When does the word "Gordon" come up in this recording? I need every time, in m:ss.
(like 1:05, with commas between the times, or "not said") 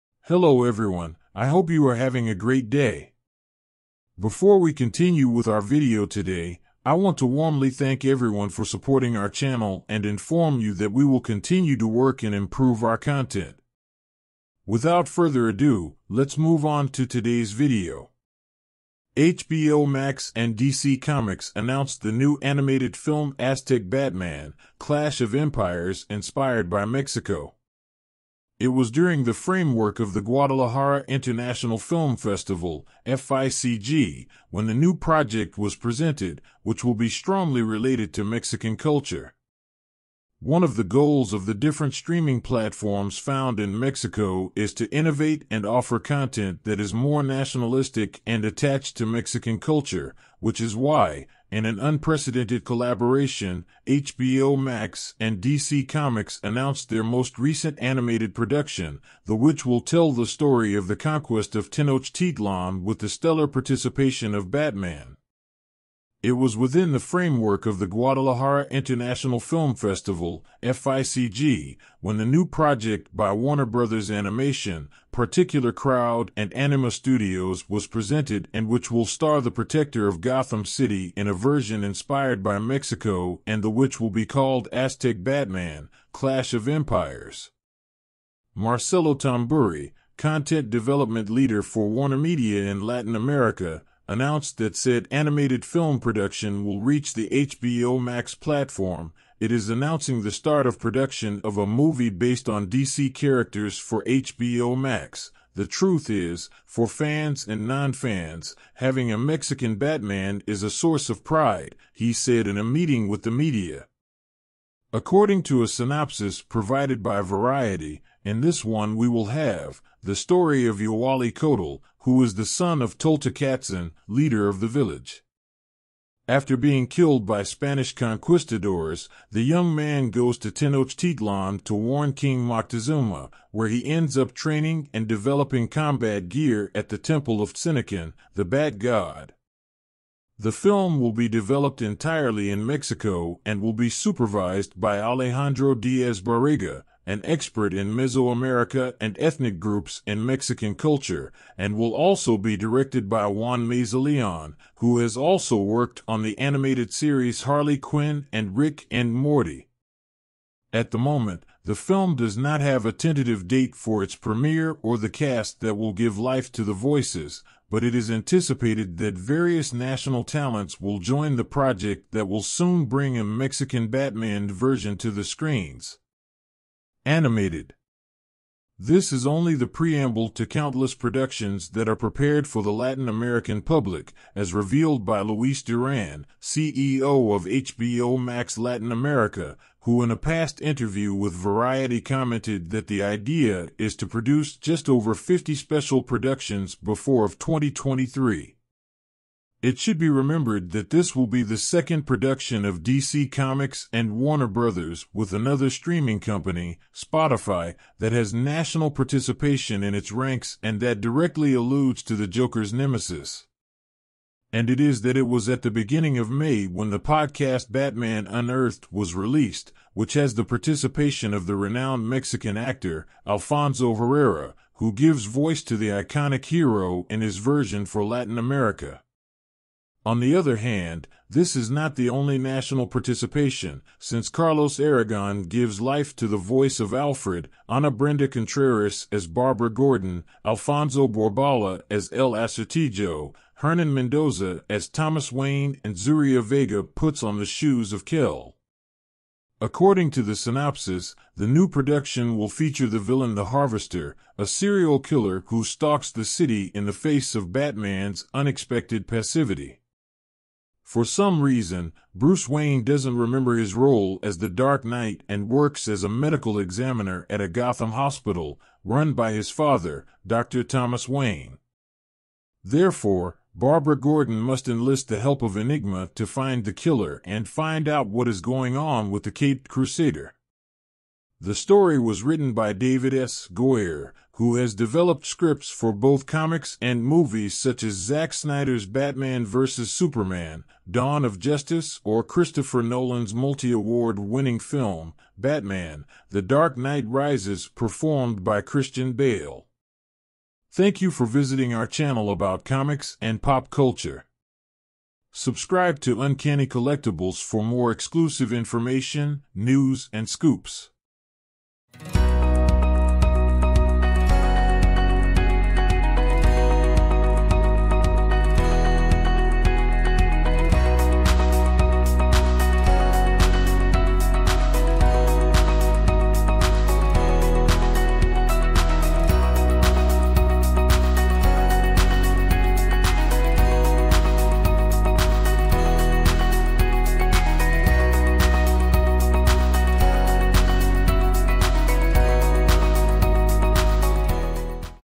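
3:59, 4:33.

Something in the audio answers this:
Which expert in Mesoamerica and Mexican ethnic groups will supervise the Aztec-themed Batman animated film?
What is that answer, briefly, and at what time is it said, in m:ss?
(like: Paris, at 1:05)
Alejandro Diaz Barriga, at 2:24.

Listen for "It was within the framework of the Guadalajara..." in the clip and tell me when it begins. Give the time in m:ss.
1:06.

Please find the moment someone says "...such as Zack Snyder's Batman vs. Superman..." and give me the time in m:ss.
4:47.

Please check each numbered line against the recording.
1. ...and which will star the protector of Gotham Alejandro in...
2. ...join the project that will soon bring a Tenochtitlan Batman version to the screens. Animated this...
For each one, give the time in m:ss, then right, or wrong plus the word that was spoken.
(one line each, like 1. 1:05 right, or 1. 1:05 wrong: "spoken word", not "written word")
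1. 1:18 wrong: "City", not "Alejandro"
2. 2:50 wrong: "Mexican", not "Tenochtitlan".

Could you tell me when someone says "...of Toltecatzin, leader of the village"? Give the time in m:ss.
2:02.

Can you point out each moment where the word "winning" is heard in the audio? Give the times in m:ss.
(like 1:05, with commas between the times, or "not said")
4:54.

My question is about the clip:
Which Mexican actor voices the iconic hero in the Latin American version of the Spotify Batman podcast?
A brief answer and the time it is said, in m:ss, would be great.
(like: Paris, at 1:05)
Alfonso Herrera, at 3:43.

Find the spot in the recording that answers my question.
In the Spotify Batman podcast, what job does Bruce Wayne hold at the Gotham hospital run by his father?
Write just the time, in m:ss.
4:26.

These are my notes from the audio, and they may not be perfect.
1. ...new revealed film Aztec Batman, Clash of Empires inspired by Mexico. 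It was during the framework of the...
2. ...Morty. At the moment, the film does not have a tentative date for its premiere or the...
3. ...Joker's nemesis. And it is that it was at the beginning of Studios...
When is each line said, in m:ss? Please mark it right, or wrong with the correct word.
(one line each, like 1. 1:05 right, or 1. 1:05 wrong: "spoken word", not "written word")
1. 0:22 wrong: "animated", not "revealed"
2. 2:39 right
3. 3:32 wrong: "May", not "Studios".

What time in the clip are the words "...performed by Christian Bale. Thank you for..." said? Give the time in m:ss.
4:57.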